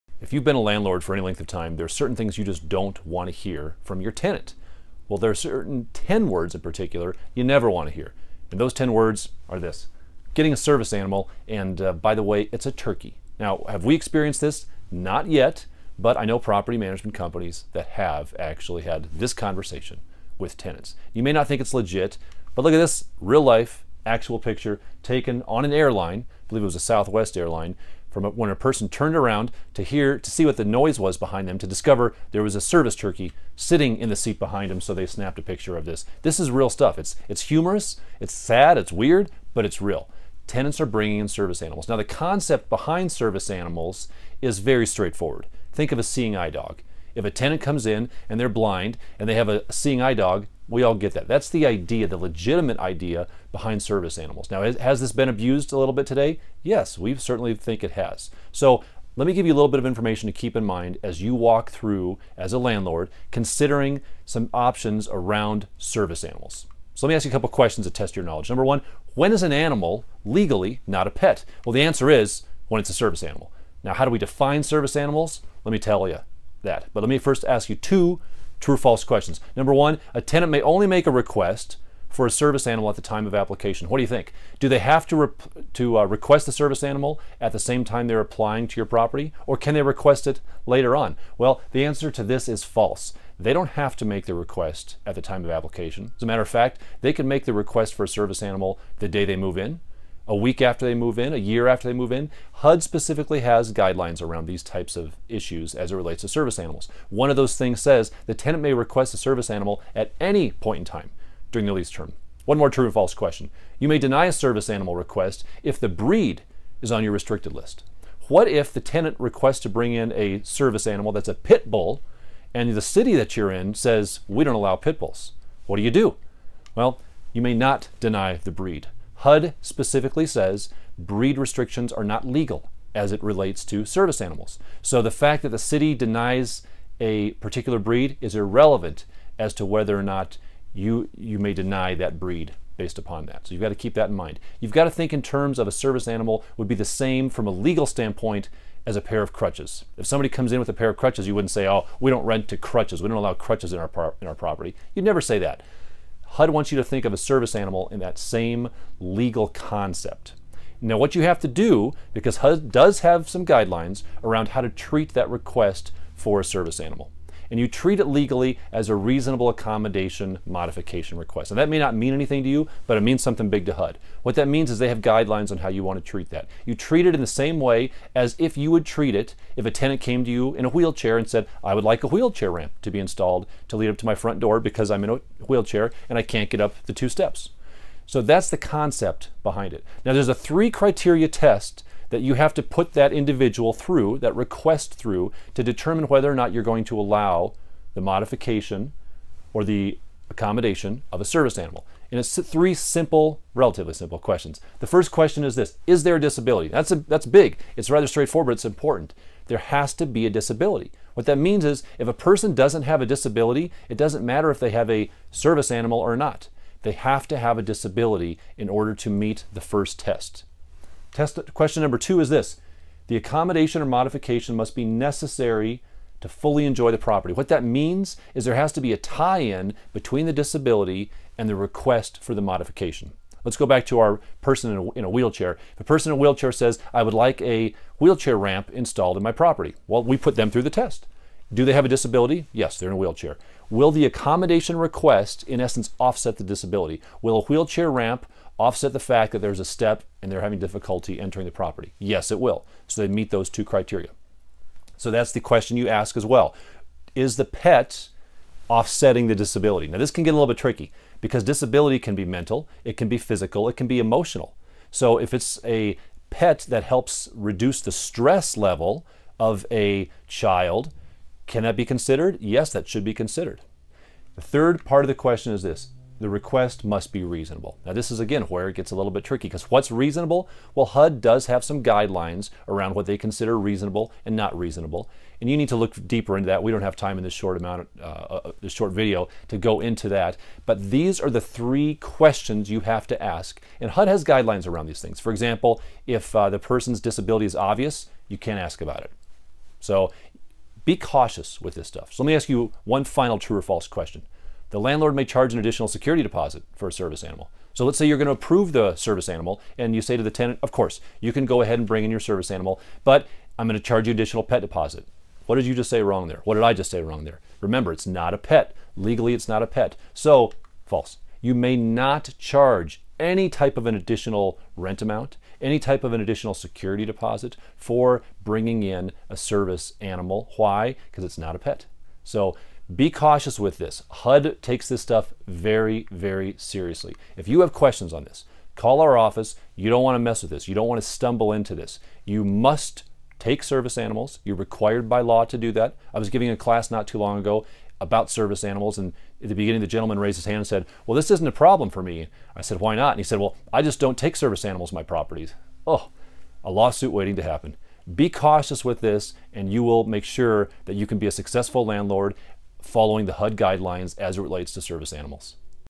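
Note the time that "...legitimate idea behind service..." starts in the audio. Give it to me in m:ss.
0:52.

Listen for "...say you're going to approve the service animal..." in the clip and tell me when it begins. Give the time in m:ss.
5:07.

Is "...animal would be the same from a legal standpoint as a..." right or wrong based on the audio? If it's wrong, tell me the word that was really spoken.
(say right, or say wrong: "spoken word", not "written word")
right.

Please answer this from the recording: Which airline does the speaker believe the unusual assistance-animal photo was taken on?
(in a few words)
Southwest.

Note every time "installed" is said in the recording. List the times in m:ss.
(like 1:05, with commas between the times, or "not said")
3:02, 3:58.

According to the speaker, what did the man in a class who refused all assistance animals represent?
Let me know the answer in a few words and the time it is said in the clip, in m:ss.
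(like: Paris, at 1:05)
a lawsuit waiting to happen, at 5:56.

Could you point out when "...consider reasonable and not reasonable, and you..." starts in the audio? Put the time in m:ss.
4:43.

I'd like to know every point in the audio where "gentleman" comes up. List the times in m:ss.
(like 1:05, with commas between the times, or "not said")
5:49.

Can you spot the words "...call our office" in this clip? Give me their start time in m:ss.
5:38.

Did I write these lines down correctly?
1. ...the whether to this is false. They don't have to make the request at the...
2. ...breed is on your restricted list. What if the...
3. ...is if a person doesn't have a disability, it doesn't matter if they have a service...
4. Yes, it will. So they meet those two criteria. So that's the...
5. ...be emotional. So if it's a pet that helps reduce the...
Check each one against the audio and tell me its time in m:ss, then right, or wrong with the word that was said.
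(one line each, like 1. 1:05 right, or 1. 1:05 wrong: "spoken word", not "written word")
1. 1:31 wrong: "answer", not "whether"
2. 1:55 right
3. 3:31 right
4. 4:11 right
5. 4:23 right.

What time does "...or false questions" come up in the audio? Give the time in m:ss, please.
1:18.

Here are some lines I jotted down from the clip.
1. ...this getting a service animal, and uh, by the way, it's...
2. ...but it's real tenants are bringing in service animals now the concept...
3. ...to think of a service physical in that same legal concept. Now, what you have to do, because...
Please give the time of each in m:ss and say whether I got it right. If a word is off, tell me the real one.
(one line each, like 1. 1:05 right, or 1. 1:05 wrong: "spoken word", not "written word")
1. 0:09 right
2. 0:39 right
3. 2:36 wrong: "animal", not "physical".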